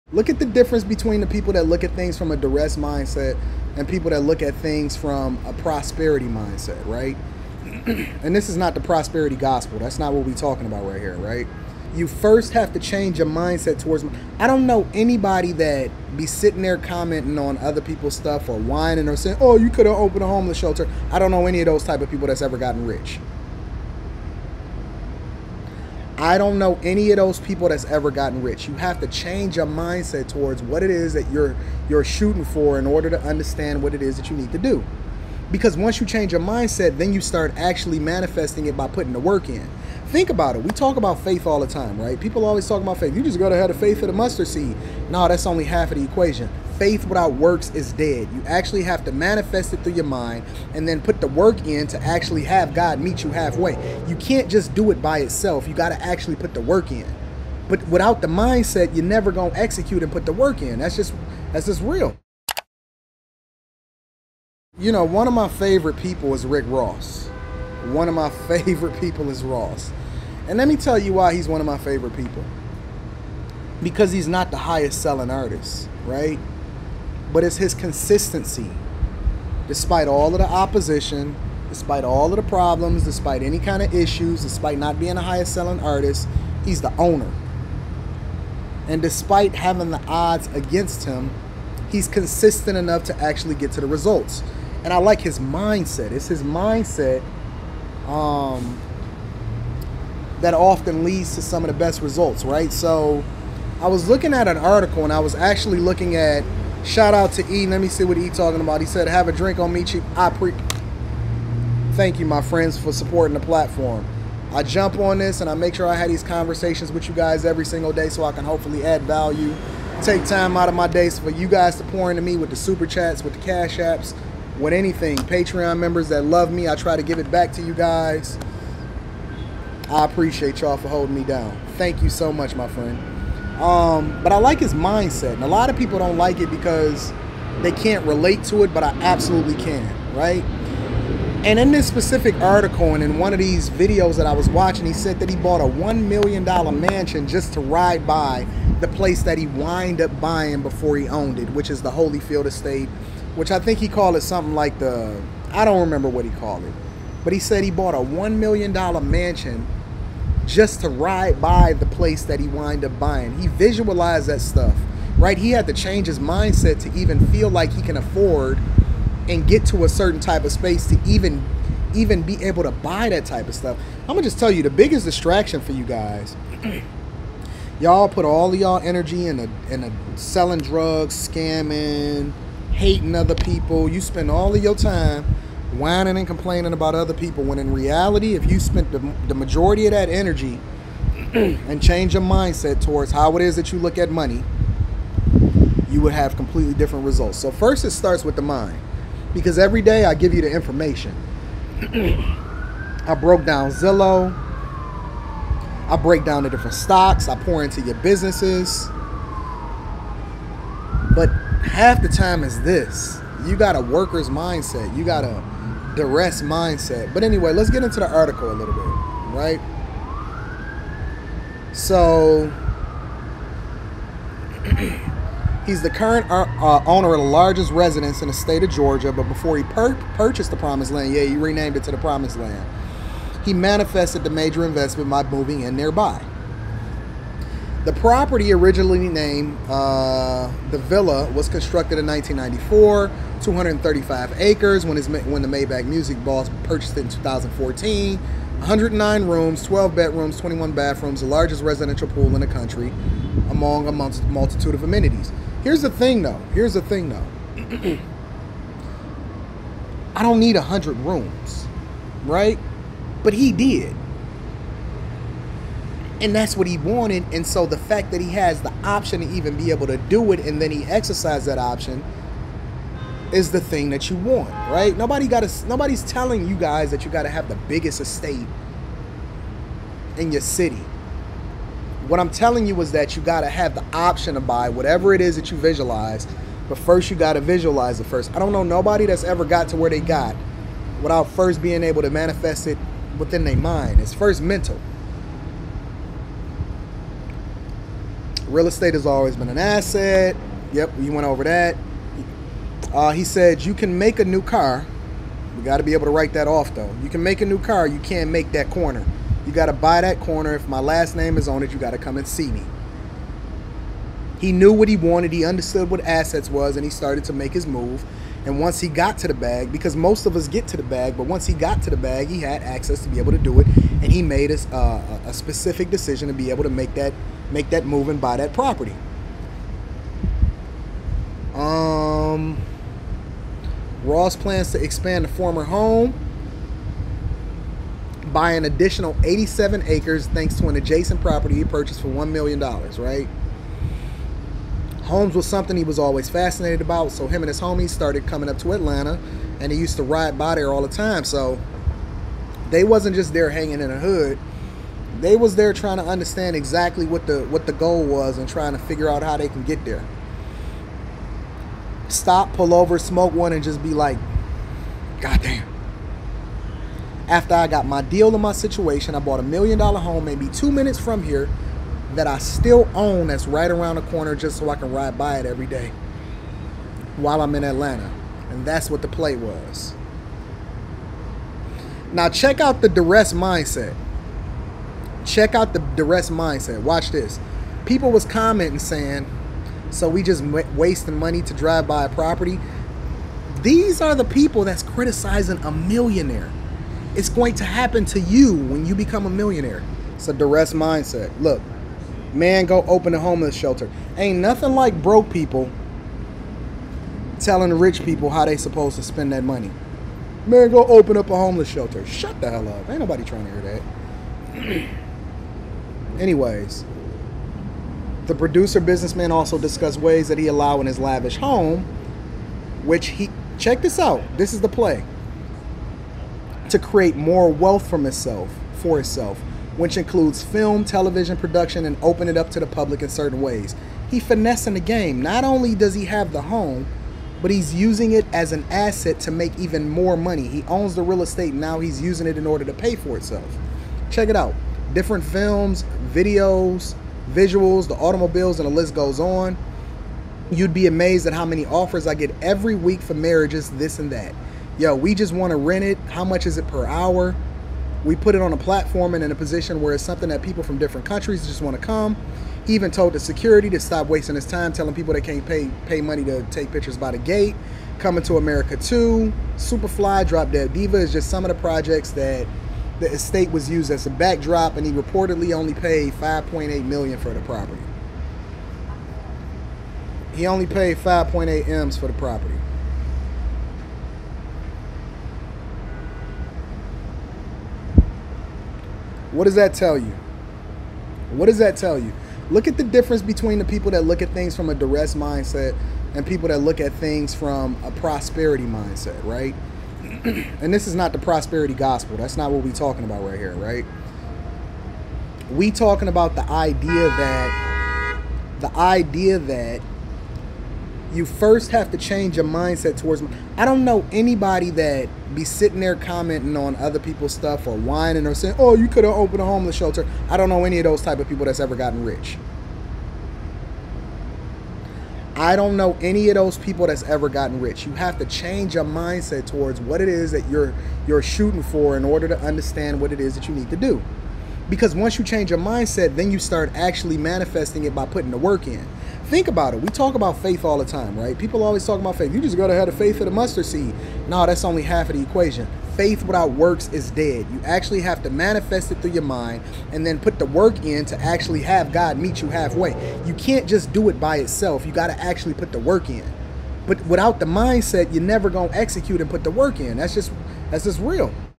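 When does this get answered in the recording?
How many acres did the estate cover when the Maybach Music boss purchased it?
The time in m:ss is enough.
4:03.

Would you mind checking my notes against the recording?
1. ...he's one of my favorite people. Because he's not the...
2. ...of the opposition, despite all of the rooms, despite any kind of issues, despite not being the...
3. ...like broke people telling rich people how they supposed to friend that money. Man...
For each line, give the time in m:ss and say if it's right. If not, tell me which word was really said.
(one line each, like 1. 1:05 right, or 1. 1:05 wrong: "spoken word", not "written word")
1. 1:11 right
2. 1:20 wrong: "problems", not "rooms"
3. 6:44 wrong: "spend", not "friend".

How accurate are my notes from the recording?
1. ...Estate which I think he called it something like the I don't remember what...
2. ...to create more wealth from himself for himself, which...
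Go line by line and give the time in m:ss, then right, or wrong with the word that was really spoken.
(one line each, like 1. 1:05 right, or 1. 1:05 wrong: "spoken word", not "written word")
1. 2:32 right
2. 7:06 right.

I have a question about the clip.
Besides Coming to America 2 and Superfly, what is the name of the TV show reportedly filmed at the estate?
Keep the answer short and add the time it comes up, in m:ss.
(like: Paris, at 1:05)
Drop Dead Diva, at 7:50.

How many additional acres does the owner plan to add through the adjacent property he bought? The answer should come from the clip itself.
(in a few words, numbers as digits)
87.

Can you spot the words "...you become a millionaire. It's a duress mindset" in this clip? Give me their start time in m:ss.
6:38.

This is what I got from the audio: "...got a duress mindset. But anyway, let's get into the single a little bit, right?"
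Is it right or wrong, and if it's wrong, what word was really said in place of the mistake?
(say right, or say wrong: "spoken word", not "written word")
wrong: "article", not "single".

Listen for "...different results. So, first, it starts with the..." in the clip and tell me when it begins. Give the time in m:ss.
3:16.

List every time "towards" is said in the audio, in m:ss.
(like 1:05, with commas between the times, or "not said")
0:13, 0:30, 3:12, 8:32, 8:49.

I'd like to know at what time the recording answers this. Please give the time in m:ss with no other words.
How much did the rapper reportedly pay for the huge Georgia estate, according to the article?
7:56.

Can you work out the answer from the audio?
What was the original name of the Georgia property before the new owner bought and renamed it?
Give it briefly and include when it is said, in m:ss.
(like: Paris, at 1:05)
the Villa, at 4:00.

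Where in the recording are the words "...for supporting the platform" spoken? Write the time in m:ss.
1:52.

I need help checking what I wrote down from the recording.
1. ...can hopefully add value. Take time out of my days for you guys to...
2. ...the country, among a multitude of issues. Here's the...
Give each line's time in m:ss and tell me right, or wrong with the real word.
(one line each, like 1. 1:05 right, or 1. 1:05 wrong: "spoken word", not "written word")
1. 1:58 right
2. 4:12 wrong: "amenities", not "issues".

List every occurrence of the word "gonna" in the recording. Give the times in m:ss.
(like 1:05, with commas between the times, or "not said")
0:59, 2:54.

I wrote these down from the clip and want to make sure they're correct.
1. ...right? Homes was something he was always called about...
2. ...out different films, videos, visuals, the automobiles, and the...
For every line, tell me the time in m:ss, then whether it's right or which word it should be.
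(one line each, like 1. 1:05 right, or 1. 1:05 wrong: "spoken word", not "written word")
1. 5:42 wrong: "fascinated", not "called"
2. 7:24 right.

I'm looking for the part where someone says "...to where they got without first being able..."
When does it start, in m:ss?
4:49.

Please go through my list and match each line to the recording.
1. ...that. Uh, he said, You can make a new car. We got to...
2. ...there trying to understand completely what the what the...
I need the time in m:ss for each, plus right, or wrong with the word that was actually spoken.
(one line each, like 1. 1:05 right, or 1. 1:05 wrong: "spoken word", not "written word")
1. 5:01 right
2. 5:55 wrong: "exactly", not "completely".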